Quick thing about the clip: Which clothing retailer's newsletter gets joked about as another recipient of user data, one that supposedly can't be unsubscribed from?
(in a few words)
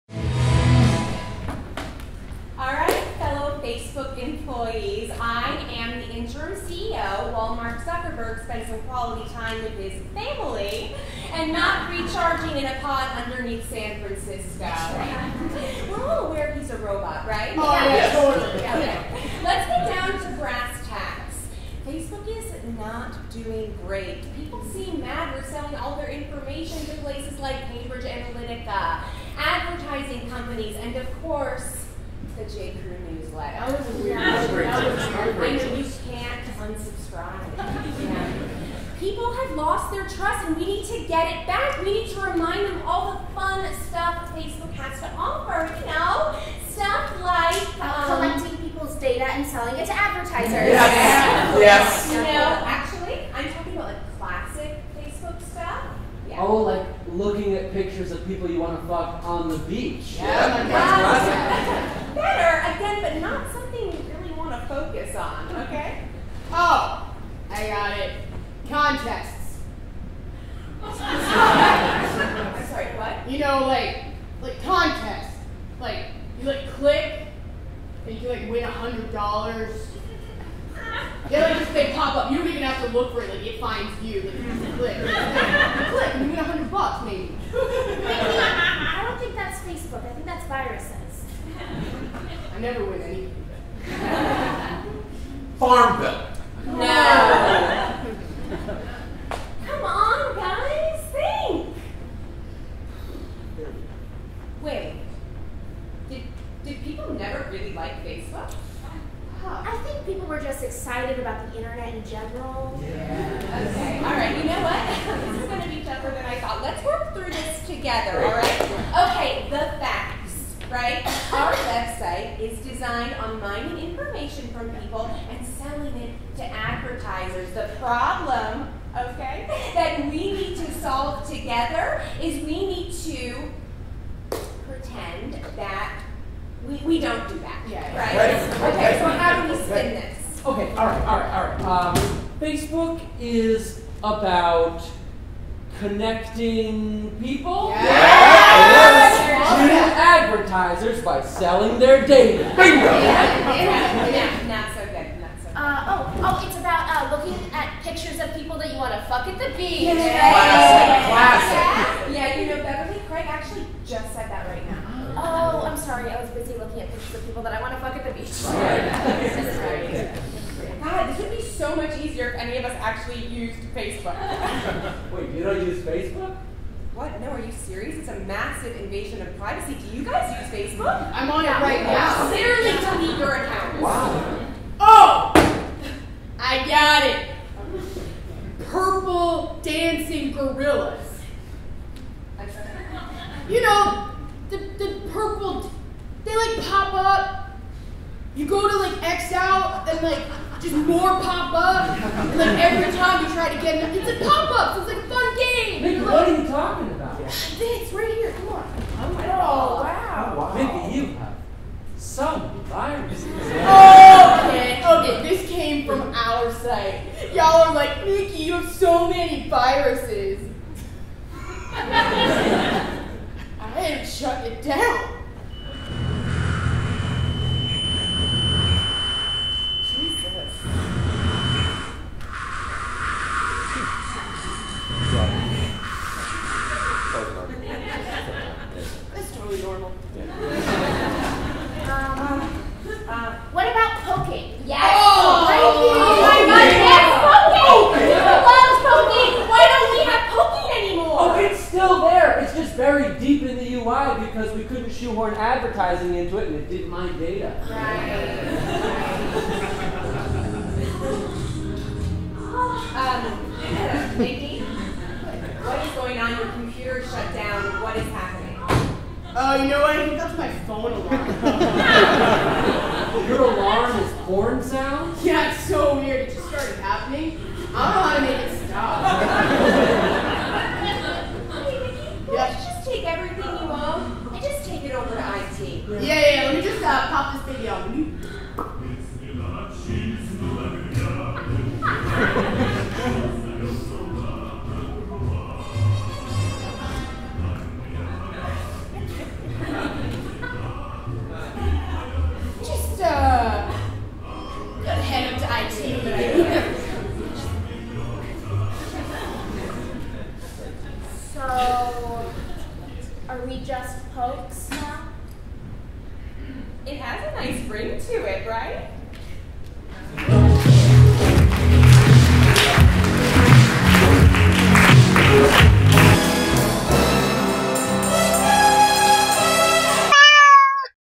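J. Crew.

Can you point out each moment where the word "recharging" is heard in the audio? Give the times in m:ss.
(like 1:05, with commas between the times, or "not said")
0:11.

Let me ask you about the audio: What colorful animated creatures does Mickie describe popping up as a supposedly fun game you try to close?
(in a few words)
Purple dancing gorillas.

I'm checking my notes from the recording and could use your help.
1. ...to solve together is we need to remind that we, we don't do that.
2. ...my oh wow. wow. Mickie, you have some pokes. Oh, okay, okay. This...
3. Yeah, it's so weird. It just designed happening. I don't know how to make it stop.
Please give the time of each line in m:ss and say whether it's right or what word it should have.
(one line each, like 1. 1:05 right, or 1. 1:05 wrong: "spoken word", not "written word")
1. 2:10 wrong: "pretend", not "remind"
2. 3:29 wrong: "viruses", not "pokes"
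3. 4:35 wrong: "started", not "designed".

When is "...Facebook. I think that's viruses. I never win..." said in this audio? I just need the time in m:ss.
1:29.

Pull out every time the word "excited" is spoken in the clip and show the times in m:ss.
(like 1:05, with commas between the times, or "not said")
1:50.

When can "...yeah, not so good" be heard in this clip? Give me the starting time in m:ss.
2:34.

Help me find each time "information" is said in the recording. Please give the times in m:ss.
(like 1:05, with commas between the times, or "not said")
0:26, 2:03.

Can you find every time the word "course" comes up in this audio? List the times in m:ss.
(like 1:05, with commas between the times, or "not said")
0:31.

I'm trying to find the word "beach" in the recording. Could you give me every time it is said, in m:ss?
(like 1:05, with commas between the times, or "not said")
0:59, 2:39, 2:48.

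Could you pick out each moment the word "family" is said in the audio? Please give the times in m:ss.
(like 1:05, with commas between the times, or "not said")
0:10.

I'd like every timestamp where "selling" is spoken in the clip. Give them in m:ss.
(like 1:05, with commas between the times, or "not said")
0:25, 0:49, 2:05, 2:31.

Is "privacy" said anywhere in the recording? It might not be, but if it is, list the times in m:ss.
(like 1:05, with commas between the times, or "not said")
2:59.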